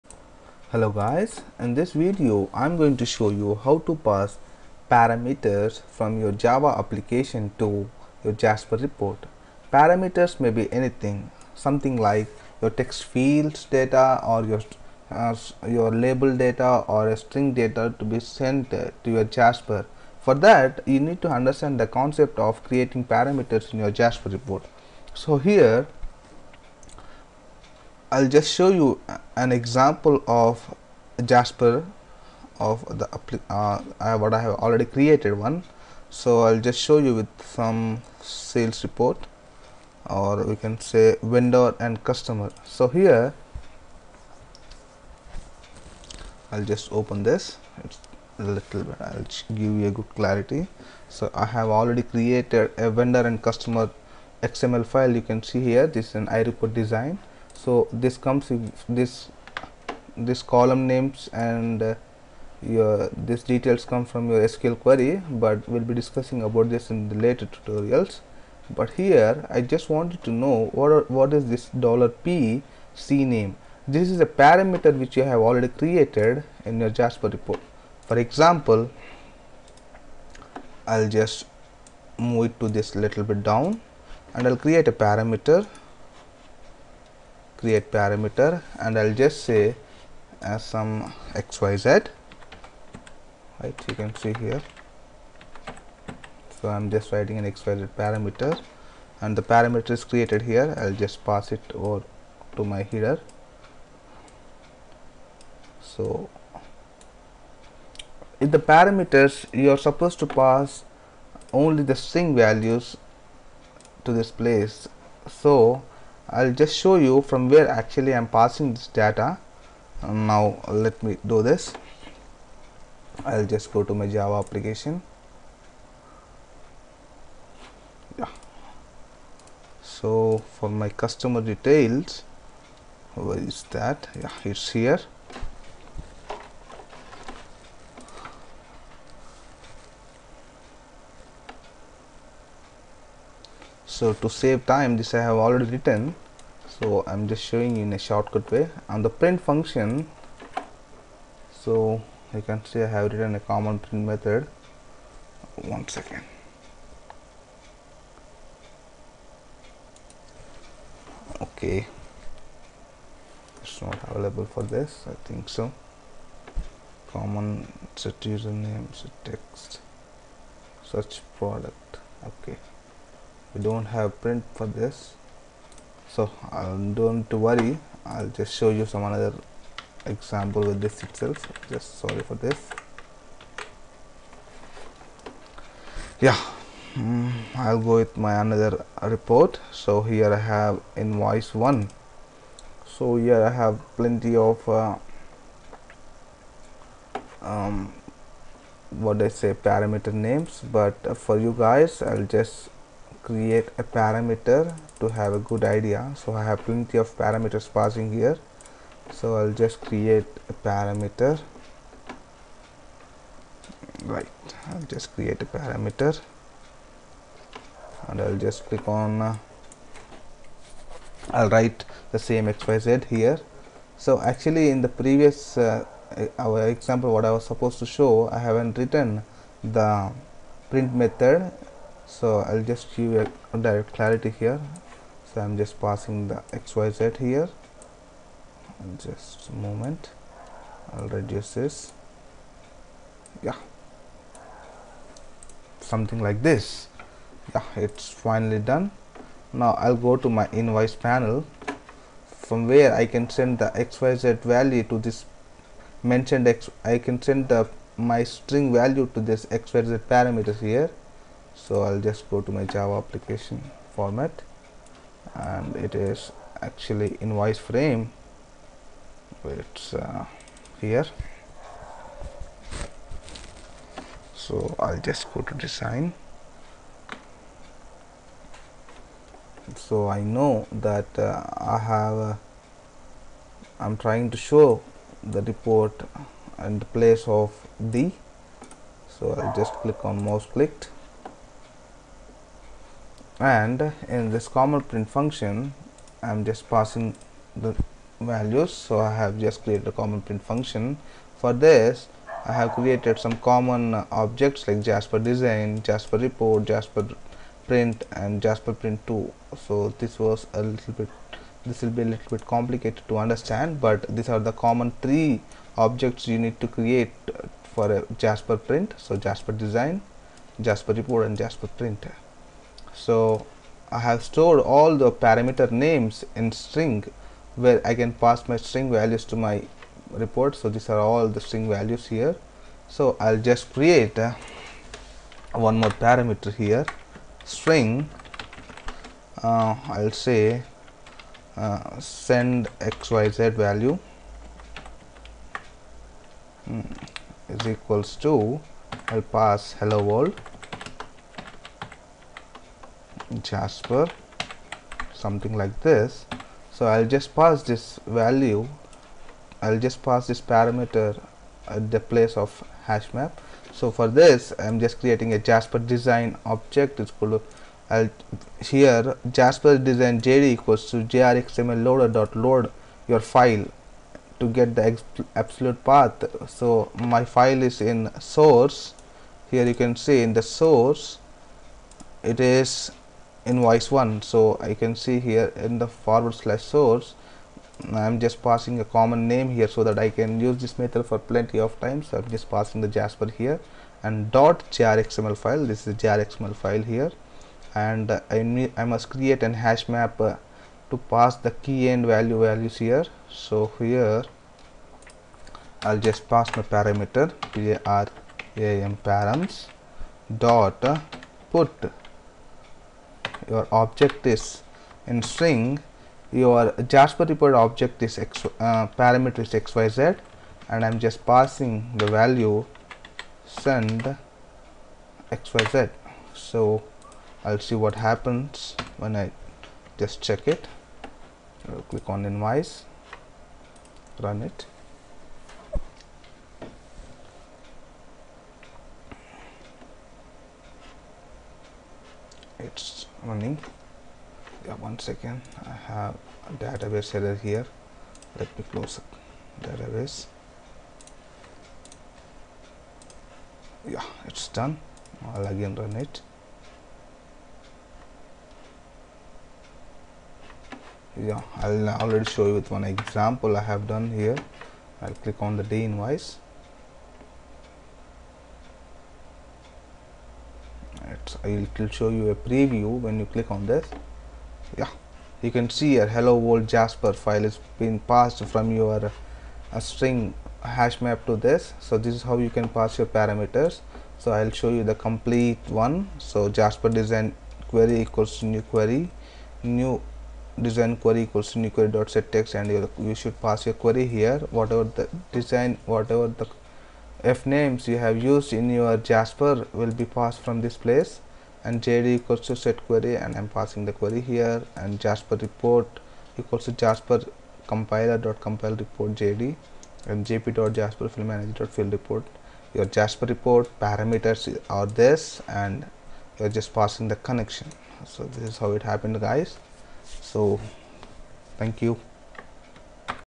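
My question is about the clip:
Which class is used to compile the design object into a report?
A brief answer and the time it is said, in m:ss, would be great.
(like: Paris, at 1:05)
jasper compiler, at 8:26.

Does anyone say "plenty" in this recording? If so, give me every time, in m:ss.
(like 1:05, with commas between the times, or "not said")
3:13, 3:26, 6:31.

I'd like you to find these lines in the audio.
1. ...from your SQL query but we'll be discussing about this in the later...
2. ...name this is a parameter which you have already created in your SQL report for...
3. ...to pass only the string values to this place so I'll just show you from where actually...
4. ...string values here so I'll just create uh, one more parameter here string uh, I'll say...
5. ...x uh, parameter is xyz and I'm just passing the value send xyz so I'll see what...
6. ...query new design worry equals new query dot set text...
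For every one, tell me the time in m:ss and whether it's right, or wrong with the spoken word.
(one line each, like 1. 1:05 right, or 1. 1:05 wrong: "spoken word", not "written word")
1. 1:04 right
2. 1:13 wrong: "Jasper", not "SQL"
3. 1:50 right
4. 5:31 right
5. 6:58 right
6. 8:08 wrong: "query", not "worry".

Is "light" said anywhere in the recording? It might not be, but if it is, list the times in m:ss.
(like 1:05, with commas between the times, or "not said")
not said.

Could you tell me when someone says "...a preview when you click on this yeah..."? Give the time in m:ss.
7:52.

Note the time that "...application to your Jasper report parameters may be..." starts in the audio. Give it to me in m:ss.
0:06.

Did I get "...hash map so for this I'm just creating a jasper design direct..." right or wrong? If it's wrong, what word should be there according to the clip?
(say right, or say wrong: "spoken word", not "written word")
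wrong: "object", not "direct".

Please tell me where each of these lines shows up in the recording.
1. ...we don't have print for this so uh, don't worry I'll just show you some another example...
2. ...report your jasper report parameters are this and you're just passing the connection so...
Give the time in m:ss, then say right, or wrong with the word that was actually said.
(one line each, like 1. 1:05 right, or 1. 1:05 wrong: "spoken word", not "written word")
1. 2:53 right
2. 8:31 right.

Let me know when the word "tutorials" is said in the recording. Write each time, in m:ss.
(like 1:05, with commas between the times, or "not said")
1:07.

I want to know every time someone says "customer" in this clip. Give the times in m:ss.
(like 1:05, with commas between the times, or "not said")
0:42, 0:53, 2:10.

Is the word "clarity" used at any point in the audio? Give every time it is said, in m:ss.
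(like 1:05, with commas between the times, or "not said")
0:50, 3:53.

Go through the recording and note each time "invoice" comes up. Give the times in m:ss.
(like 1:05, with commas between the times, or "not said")
3:10, 4:10, 4:27, 6:23, 7:12, 7:45.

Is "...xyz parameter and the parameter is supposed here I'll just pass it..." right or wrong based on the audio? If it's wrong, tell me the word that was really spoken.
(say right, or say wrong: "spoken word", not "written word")
wrong: "created", not "supposed".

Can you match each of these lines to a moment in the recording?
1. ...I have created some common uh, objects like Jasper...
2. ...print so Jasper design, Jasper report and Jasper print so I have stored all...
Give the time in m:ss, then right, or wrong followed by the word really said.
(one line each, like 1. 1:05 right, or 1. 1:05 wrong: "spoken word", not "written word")
1. 5:02 right
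2. 5:18 right.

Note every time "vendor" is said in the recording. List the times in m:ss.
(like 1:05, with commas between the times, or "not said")
0:41, 0:52.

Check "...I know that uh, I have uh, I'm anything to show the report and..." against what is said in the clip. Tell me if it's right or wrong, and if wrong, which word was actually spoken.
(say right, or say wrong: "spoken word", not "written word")
wrong: "trying", not "anything".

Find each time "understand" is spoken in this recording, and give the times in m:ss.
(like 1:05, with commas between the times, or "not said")
0:21, 5:13.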